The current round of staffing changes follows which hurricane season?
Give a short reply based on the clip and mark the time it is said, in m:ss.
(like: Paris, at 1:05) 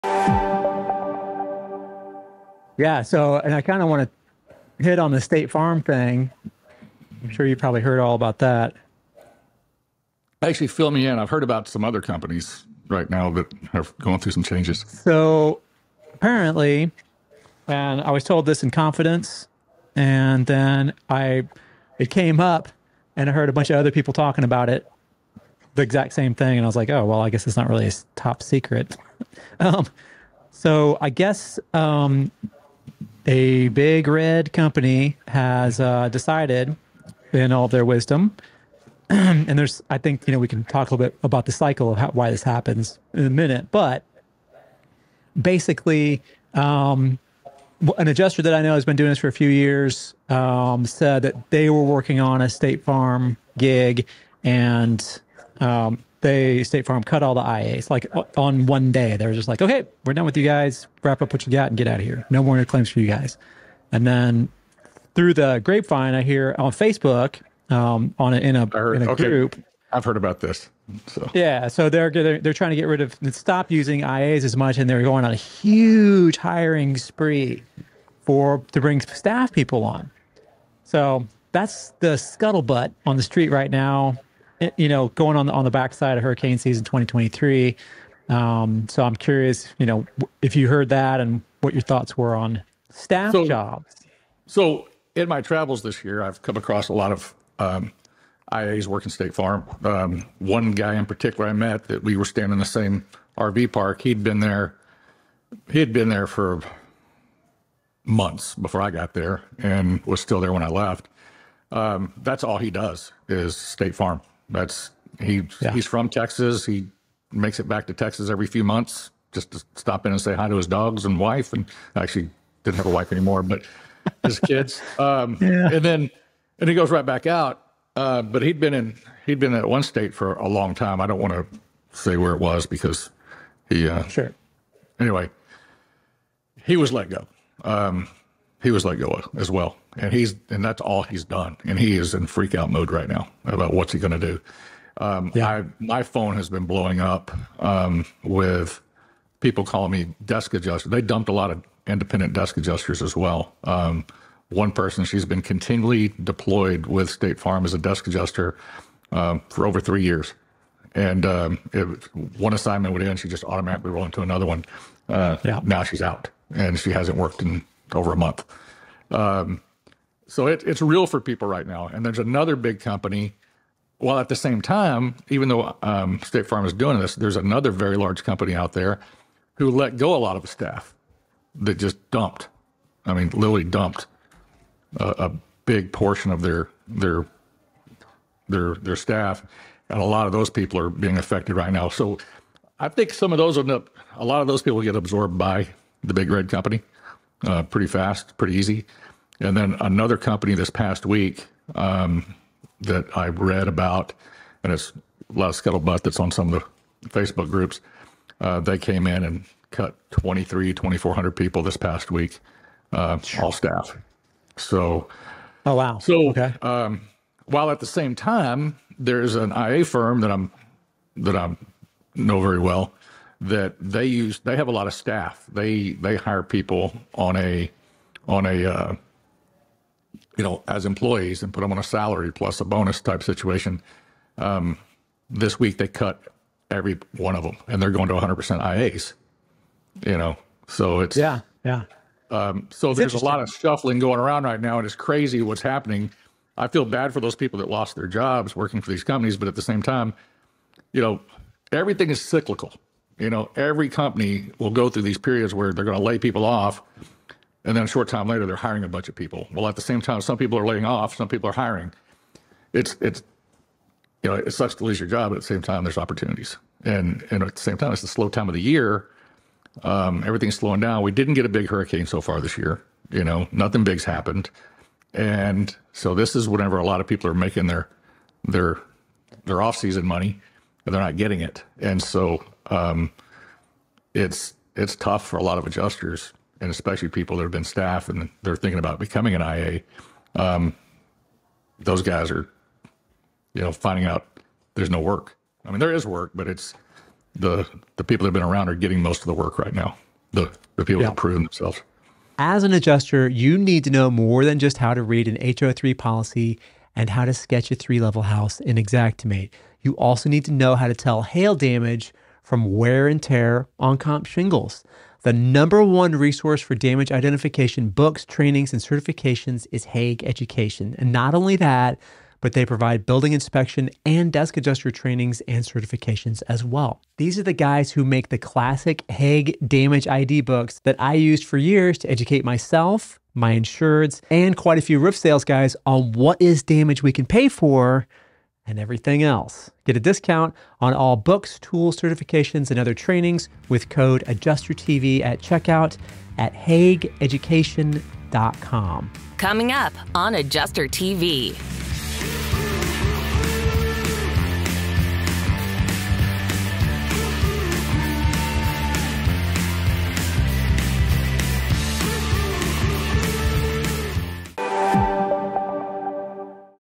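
2023, at 1:26.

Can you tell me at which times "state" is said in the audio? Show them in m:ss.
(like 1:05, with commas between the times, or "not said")
0:05, 0:52, 0:56, 1:39, 1:53, 2:09, 2:37, 2:56.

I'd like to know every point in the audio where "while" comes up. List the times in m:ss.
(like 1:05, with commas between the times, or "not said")
2:53, 3:37.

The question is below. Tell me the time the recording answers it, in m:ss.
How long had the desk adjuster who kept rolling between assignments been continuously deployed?
2:39.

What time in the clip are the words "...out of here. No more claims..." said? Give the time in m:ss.
1:01.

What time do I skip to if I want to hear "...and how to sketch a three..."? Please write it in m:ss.
5:06.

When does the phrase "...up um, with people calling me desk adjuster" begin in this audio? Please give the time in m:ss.
2:26.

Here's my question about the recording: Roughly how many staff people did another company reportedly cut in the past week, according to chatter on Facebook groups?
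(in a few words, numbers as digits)
2,400.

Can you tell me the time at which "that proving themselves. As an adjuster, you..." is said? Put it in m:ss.
5:01.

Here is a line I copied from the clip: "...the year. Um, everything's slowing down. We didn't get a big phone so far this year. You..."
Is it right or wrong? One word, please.
wrong.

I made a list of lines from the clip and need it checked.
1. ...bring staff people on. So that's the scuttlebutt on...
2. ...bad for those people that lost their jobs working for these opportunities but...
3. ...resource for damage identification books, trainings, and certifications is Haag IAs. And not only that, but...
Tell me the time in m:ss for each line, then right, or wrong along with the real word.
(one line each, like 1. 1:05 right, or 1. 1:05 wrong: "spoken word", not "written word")
1. 1:18 right
2. 4:06 wrong: "companies", not "opportunities"
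3. 5:16 wrong: "Education", not "IAs".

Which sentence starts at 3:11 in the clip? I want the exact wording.
So I think some of those end up.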